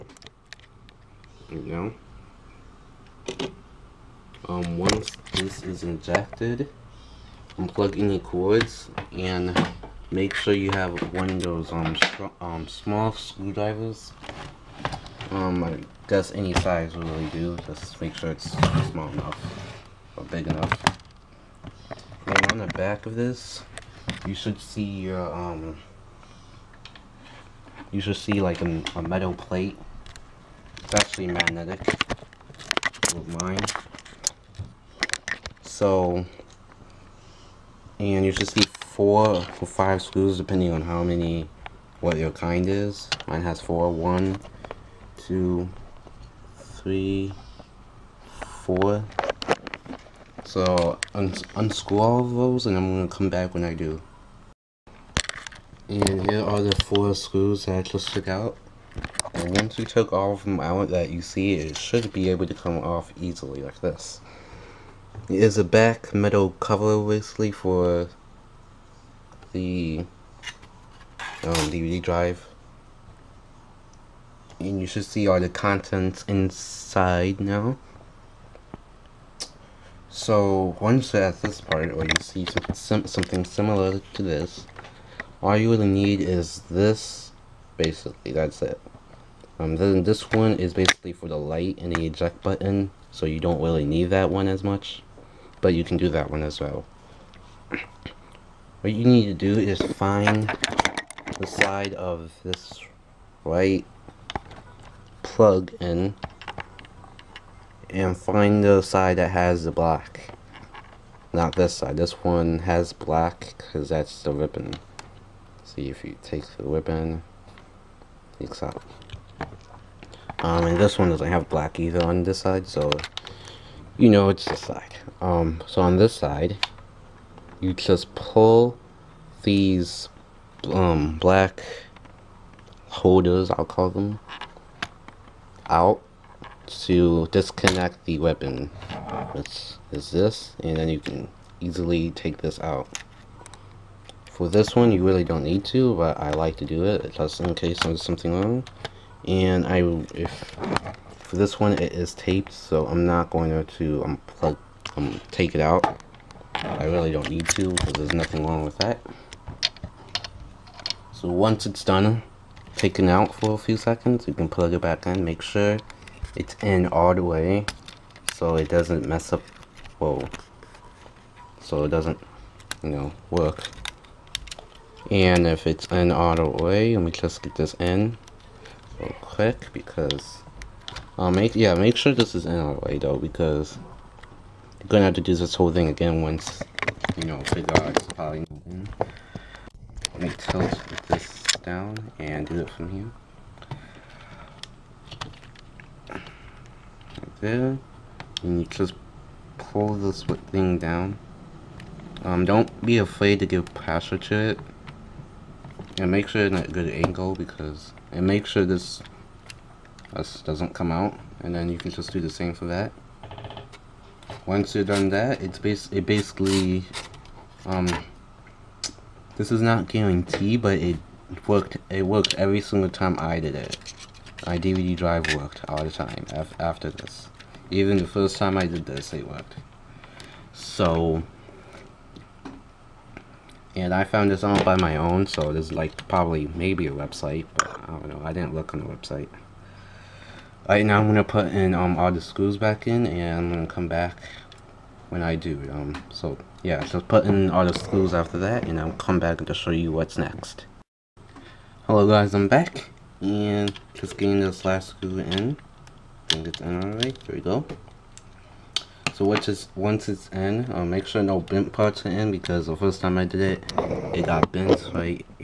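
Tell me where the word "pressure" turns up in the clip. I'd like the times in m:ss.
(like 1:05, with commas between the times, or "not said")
3:23.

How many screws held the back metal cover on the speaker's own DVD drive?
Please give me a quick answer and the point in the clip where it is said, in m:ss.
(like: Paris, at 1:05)
4, at 0:43.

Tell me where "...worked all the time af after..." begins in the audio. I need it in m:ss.
3:45.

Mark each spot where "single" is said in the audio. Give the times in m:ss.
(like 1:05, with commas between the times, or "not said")
3:42.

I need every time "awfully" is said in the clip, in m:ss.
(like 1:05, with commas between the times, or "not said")
not said.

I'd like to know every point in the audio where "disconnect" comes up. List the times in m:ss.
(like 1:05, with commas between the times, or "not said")
2:17.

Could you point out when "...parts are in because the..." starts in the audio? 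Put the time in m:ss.
4:21.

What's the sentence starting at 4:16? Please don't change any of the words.
I think it's in already, there we go.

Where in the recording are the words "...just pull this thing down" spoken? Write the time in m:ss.
3:18.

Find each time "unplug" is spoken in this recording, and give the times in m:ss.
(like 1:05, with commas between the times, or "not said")
0:07, 2:34.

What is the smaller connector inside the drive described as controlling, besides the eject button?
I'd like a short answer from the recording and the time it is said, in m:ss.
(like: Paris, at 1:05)
The light, at 1:31.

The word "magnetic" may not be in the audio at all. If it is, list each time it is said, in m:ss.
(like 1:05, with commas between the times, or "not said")
0:31.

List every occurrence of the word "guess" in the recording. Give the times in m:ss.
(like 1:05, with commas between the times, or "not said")
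0:16.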